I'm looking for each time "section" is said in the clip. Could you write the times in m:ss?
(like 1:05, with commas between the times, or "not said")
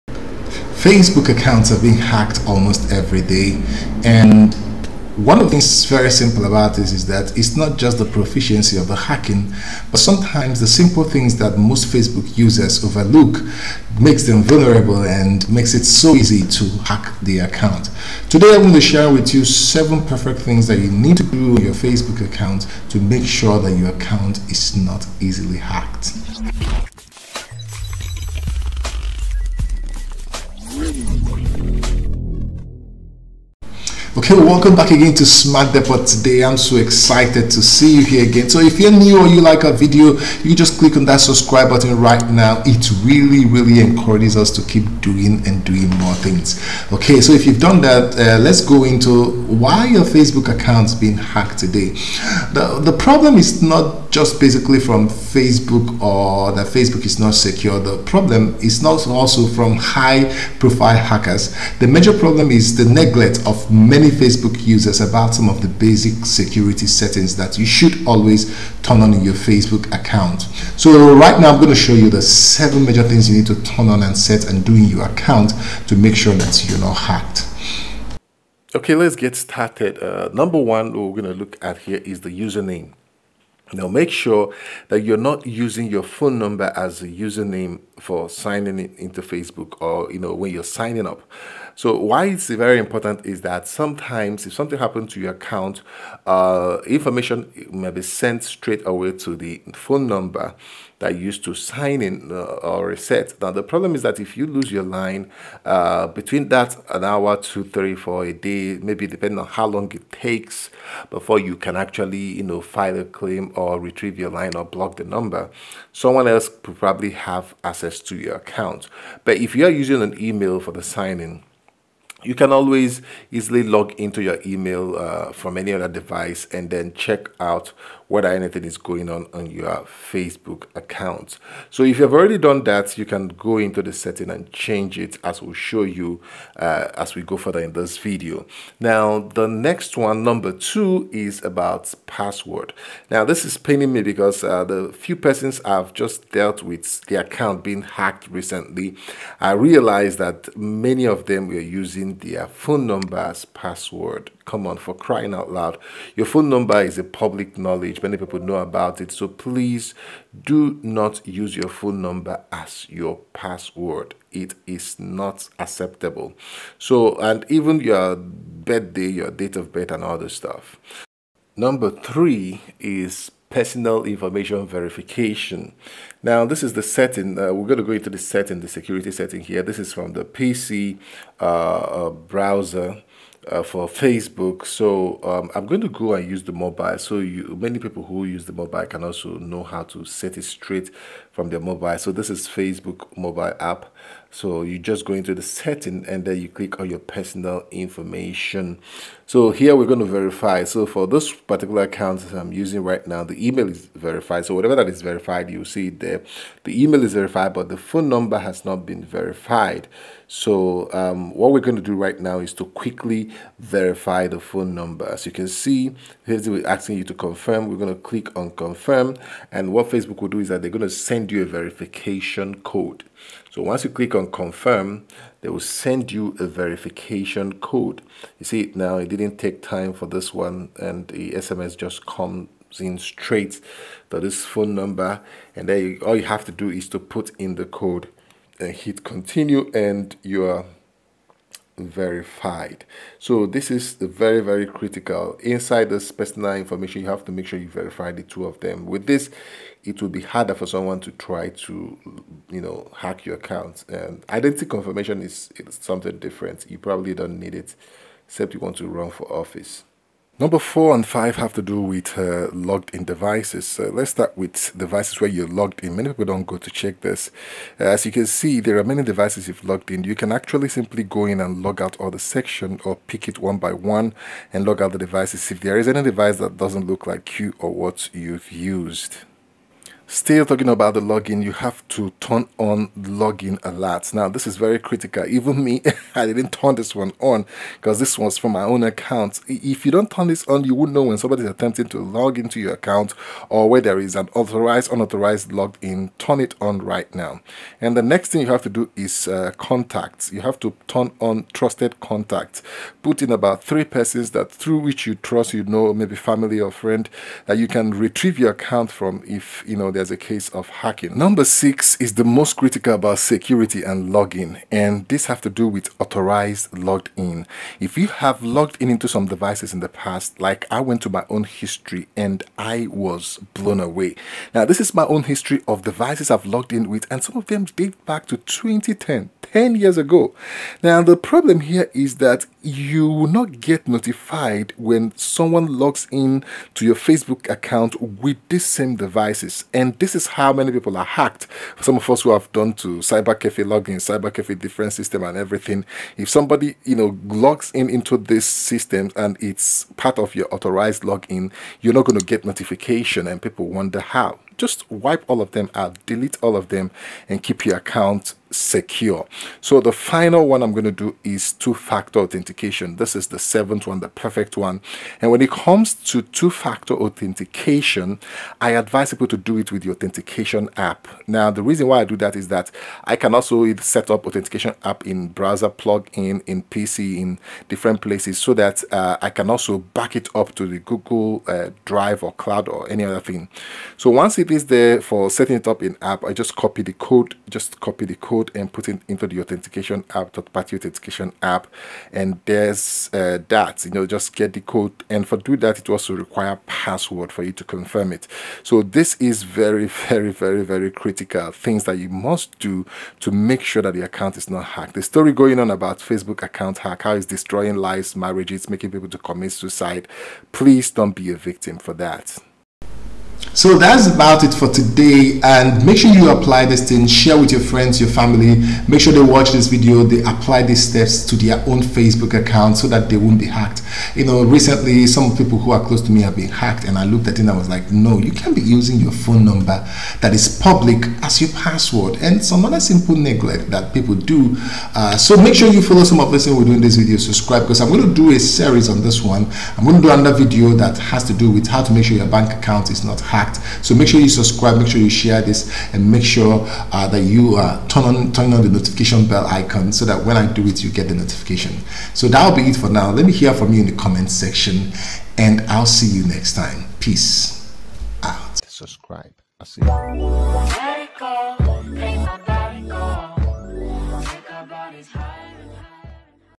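4:32, 7:34.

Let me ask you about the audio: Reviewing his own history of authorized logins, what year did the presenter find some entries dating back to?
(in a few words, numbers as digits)
2010.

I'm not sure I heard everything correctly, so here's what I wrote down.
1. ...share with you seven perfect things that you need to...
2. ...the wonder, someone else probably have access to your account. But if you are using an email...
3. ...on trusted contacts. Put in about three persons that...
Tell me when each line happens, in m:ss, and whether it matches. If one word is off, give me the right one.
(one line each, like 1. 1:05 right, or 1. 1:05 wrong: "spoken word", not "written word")
1. 0:18 right
2. 1:54 wrong: "number", not "wonder"
3. 5:01 right.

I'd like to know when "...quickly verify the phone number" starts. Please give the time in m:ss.
3:32.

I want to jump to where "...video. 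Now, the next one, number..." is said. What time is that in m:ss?
2:17.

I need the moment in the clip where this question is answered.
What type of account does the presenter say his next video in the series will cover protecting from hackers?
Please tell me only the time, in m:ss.
7:22.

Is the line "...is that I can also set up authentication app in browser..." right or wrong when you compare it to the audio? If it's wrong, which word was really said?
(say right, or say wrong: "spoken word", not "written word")
right.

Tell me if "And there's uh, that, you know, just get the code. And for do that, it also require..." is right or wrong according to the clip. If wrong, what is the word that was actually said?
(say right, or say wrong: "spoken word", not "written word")
right.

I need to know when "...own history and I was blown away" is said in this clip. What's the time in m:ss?
5:21.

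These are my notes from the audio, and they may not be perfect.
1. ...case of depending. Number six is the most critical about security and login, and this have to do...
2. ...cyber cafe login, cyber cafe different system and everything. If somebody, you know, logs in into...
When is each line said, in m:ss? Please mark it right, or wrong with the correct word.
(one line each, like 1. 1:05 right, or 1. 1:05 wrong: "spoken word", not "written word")
1. 5:10 wrong: "hacking", not "depending"
2. 5:42 right.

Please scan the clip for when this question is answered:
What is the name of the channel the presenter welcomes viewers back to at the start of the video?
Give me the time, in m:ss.
0:35.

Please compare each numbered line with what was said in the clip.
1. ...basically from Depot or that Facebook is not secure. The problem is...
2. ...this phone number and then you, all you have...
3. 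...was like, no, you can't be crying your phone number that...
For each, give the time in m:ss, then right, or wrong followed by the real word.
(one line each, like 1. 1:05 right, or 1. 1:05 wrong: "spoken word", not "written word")
1. 0:54 wrong: "Facebook", not "Depot"
2. 3:54 right
3. 7:07 wrong: "using", not "crying".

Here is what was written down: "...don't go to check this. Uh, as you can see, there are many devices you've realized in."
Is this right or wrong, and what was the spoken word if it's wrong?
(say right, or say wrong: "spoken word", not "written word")
wrong: "logged", not "realized".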